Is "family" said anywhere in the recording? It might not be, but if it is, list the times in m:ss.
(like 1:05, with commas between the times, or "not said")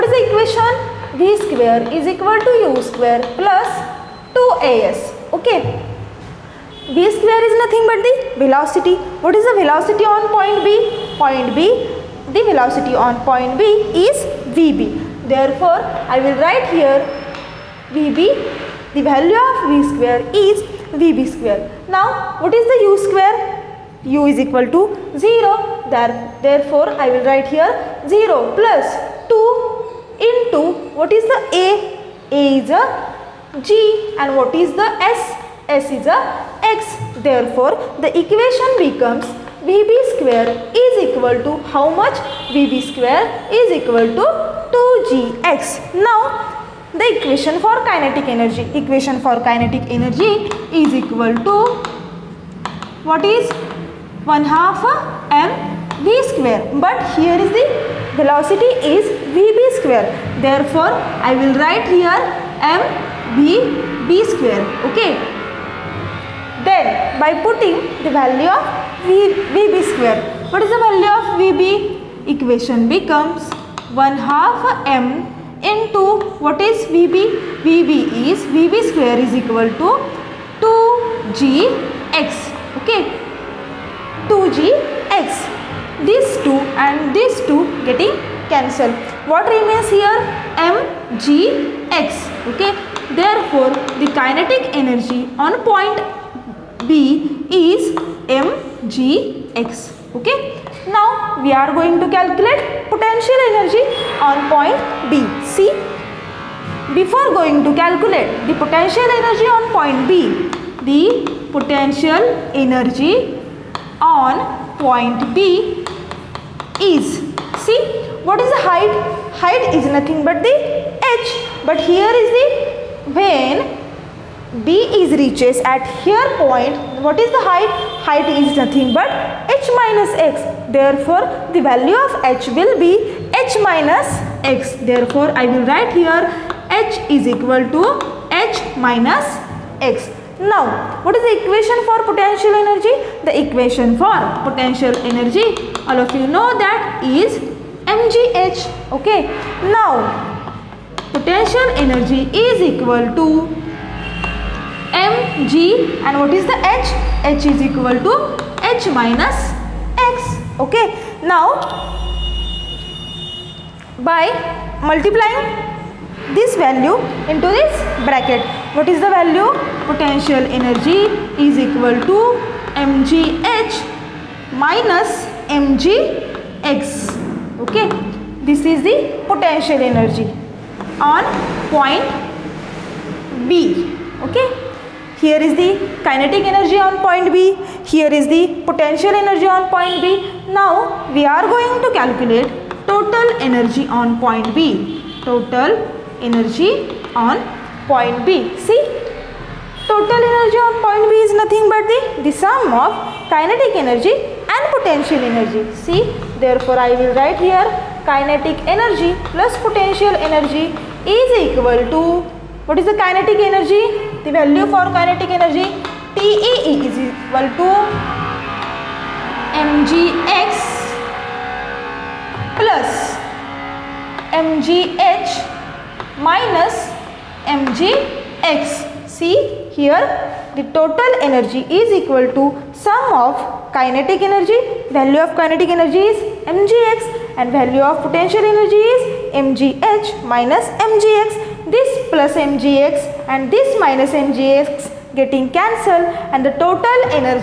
not said.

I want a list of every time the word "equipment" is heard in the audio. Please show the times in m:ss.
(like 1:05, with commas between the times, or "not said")
not said.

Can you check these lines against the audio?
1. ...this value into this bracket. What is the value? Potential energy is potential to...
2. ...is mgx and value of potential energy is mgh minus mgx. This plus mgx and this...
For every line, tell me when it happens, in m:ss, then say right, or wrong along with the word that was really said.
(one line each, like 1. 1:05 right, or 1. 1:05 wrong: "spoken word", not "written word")
1. 2:46 wrong: "equal", not "potential"
2. 3:56 right.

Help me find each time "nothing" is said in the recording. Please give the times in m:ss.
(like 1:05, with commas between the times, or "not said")
0:07, 1:59, 2:08, 3:21.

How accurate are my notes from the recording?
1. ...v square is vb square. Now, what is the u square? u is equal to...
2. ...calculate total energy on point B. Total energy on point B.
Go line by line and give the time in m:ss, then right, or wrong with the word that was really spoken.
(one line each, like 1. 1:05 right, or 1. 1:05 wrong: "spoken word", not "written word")
1. 0:19 right
2. 3:11 right.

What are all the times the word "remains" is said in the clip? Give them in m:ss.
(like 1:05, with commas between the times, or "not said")
1:29.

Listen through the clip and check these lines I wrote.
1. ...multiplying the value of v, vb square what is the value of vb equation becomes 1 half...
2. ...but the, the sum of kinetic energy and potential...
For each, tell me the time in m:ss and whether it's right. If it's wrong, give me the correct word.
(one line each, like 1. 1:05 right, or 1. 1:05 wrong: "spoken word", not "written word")
1. 1:07 wrong: "putting", not "multiplying"
2. 3:21 right.